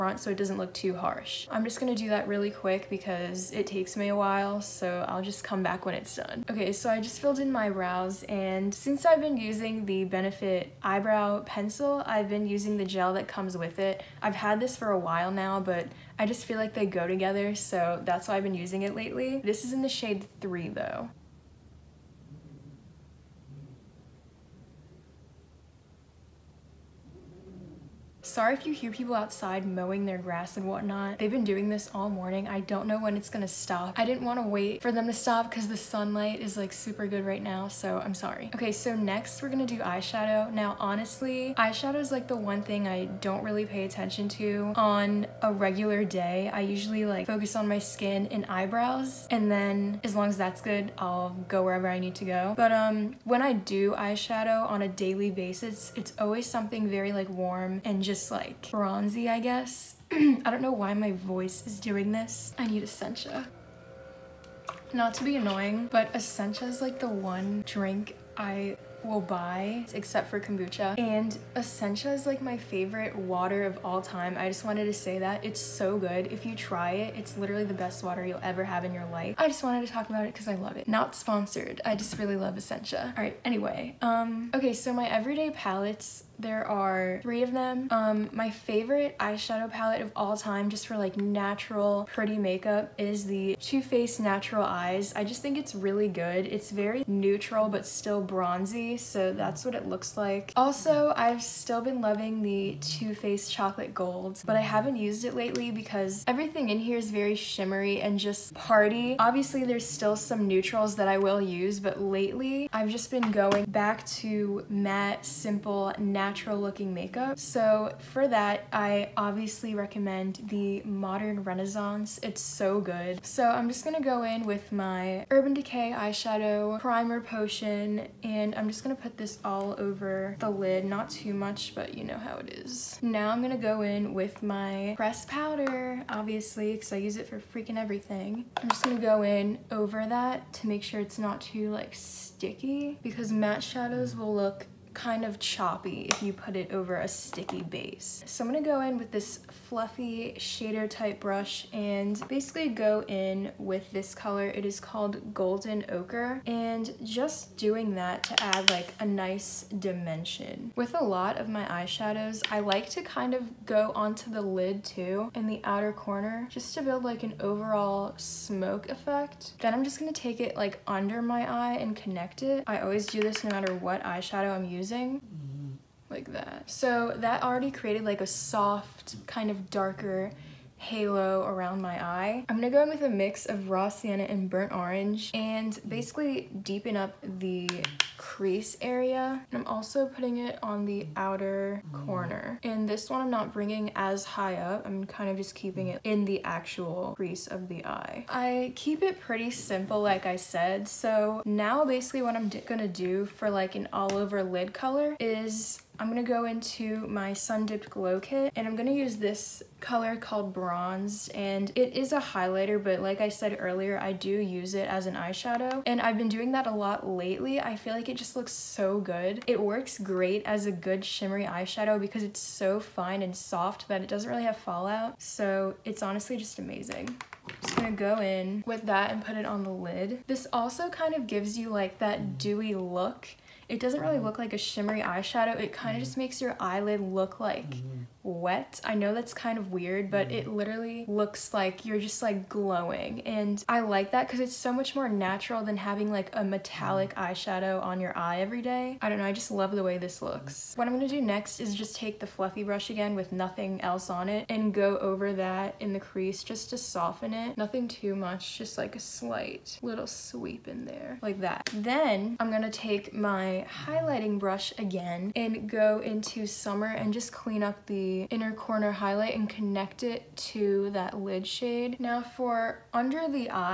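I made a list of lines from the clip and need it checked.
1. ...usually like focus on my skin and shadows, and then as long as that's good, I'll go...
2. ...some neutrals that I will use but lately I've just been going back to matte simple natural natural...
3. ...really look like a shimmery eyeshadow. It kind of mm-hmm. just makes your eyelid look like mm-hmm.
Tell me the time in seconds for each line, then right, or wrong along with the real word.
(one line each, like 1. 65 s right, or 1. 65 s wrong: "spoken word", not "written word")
1. 46 s wrong: "eyebrows", not "shadows"
2. 110 s right
3. 233 s right.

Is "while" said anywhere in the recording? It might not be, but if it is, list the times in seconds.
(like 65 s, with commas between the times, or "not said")
4 s, 14 s.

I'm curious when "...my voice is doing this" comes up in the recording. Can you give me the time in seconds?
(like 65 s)
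60 s.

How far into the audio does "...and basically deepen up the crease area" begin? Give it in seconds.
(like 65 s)
185 s.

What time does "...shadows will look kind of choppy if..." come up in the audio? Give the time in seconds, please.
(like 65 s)
143 s.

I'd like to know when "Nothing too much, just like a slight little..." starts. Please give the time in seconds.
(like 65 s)
257 s.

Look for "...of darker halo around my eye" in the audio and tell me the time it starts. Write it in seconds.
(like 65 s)
179 s.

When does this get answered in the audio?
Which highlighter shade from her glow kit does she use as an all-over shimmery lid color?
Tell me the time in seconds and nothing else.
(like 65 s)
210 s.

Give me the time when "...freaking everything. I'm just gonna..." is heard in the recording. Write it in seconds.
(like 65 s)
137 s.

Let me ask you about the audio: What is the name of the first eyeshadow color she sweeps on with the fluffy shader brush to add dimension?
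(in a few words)
Golden Ochre.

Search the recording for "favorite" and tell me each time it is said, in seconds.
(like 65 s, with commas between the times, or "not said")
72 s, 88 s.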